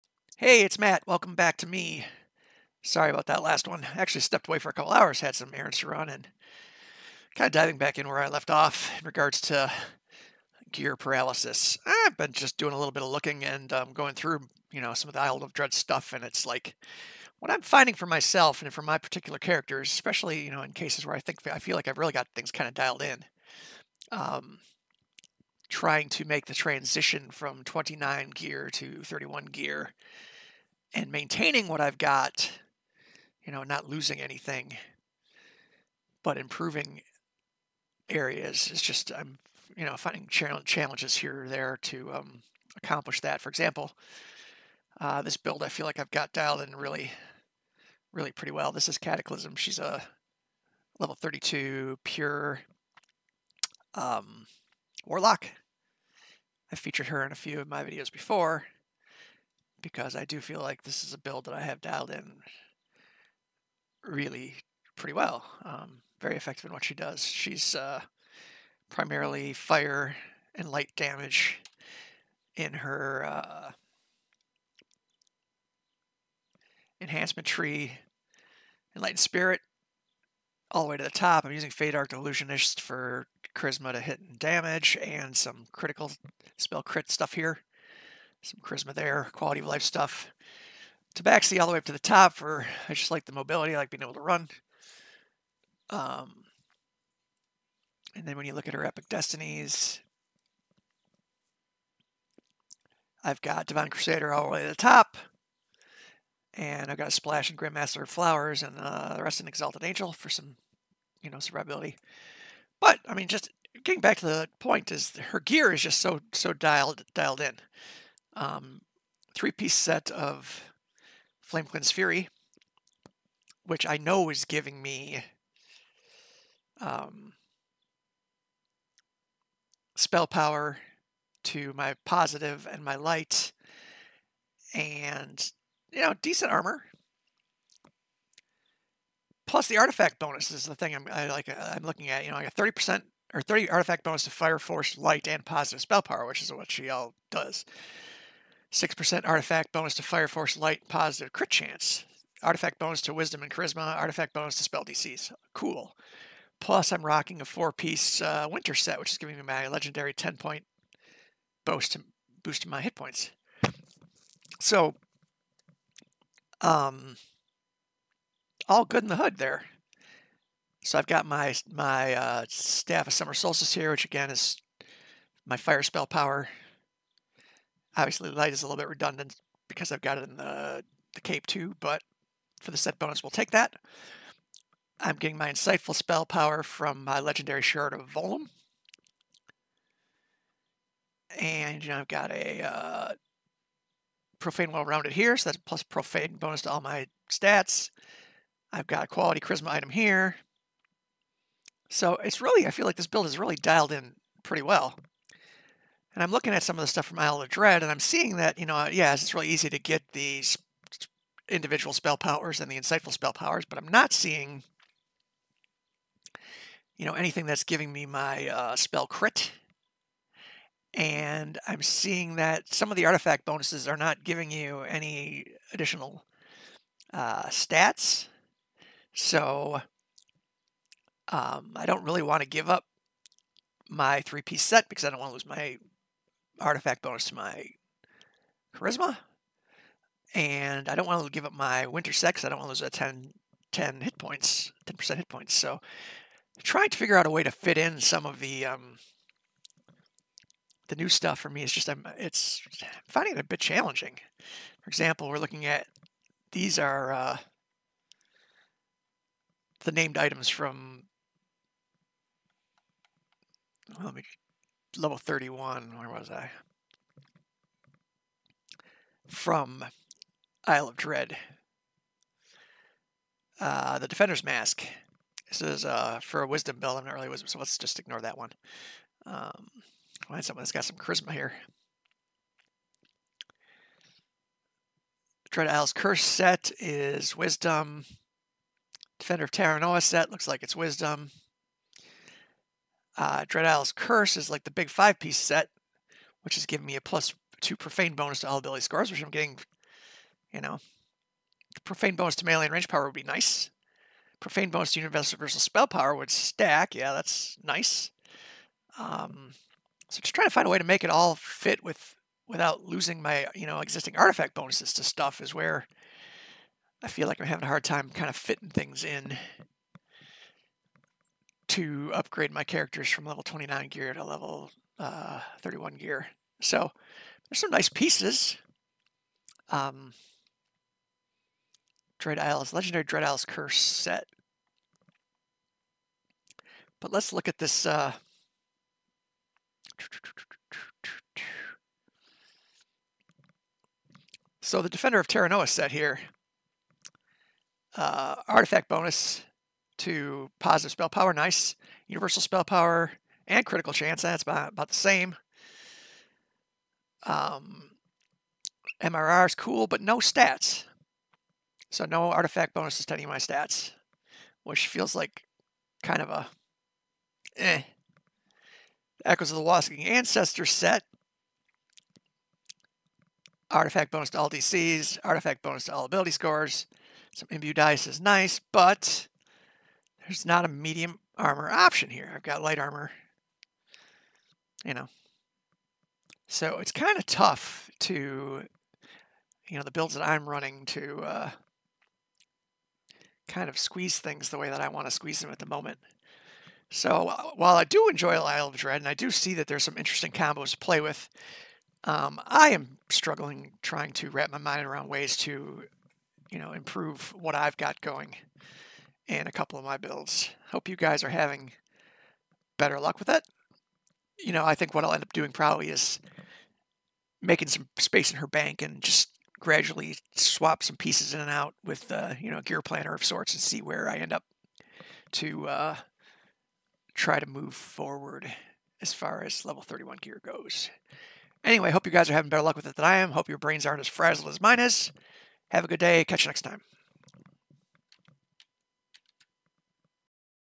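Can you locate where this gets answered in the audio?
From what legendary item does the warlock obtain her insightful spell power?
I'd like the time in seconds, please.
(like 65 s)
187 s.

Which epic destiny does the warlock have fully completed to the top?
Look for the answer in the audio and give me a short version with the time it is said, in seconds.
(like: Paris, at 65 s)
Divine Crusader, at 103 s.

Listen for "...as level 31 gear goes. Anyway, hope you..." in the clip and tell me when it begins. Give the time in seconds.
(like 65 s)
429 s.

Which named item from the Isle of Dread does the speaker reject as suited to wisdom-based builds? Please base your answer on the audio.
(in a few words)
Defender's Mask.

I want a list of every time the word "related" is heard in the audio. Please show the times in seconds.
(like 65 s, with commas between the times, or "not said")
not said.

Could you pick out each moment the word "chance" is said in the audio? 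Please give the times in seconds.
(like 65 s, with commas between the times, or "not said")
151 s, 353 s.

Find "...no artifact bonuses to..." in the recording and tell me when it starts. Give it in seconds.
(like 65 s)
362 s.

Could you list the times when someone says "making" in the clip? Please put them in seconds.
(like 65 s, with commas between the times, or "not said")
417 s.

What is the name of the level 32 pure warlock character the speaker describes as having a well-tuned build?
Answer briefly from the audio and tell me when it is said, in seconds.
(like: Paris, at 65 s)
Cataclysm, at 48 s.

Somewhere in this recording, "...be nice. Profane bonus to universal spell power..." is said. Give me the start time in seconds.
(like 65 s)
303 s.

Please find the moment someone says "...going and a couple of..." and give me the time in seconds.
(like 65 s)
407 s.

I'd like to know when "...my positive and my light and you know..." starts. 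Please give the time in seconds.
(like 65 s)
131 s.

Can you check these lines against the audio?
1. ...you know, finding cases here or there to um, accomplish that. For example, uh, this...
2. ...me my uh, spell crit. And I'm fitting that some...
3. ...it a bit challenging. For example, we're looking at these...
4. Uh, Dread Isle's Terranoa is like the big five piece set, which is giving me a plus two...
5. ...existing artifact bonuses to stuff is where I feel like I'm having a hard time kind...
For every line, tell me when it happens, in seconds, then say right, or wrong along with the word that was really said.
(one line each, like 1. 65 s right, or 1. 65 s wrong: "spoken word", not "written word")
1. 39 s wrong: "challenges", not "cases"
2. 217 s wrong: "seeing", not "fitting"
3. 253 s right
4. 293 s wrong: "Curse", not "Terranoa"
5. 313 s right.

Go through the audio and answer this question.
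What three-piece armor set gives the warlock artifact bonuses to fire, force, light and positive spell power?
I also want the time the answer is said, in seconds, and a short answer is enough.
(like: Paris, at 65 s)
Flamecleansed Fury, at 121 s.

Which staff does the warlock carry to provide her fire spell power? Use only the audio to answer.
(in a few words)
Staff of Summer Solstice.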